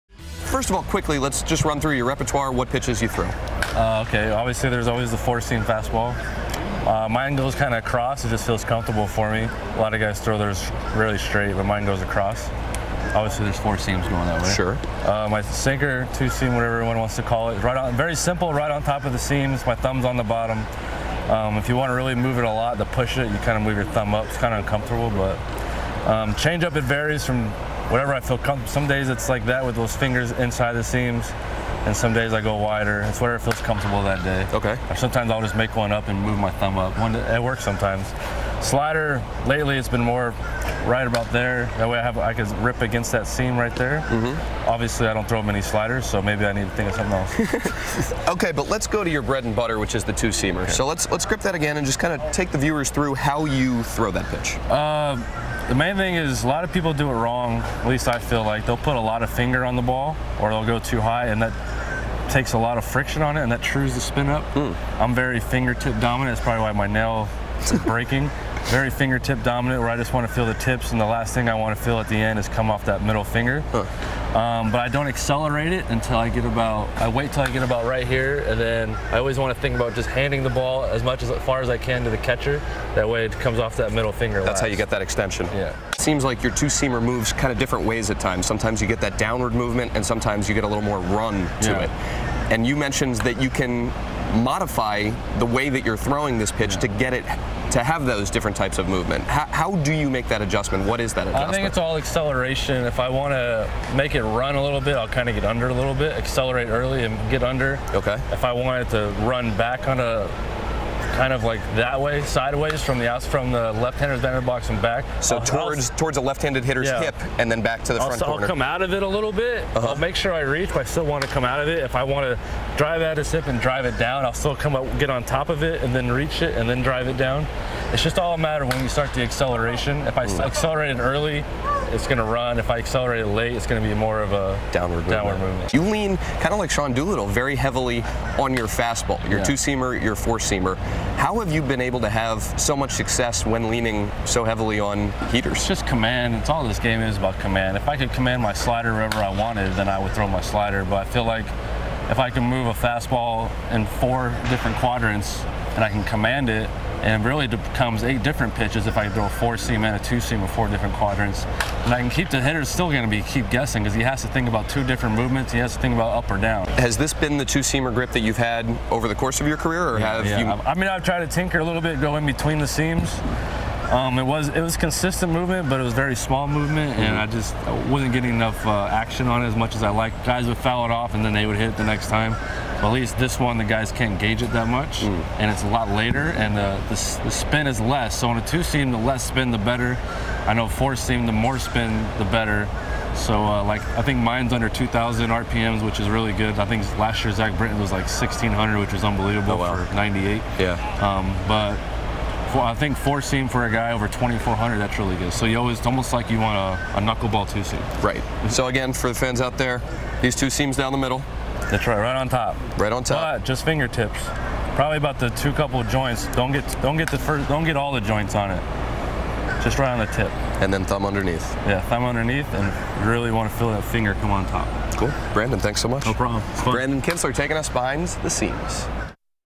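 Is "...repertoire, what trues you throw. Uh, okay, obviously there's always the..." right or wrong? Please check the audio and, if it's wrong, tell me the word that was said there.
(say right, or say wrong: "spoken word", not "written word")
wrong: "pitches", not "trues".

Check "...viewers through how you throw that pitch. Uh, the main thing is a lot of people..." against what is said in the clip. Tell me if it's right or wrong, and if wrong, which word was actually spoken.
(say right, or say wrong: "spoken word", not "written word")
right.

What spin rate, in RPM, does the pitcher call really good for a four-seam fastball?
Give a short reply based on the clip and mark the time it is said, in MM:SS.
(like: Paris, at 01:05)
2,400, at 03:24.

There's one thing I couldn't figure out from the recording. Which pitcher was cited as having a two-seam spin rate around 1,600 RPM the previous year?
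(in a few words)
Zach Britton.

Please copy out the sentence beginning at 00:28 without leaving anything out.
Some days it's like that with those fingers inside the seams, and some days I go wider.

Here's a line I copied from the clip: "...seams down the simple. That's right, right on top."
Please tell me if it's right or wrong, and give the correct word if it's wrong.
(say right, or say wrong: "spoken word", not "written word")
wrong: "middle", not "simple".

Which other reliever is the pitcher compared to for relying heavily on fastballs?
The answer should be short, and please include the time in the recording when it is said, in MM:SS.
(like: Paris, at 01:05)
Sean Doolittle, at 02:16.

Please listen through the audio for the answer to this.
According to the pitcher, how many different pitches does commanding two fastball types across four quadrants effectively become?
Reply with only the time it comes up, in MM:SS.
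02:38.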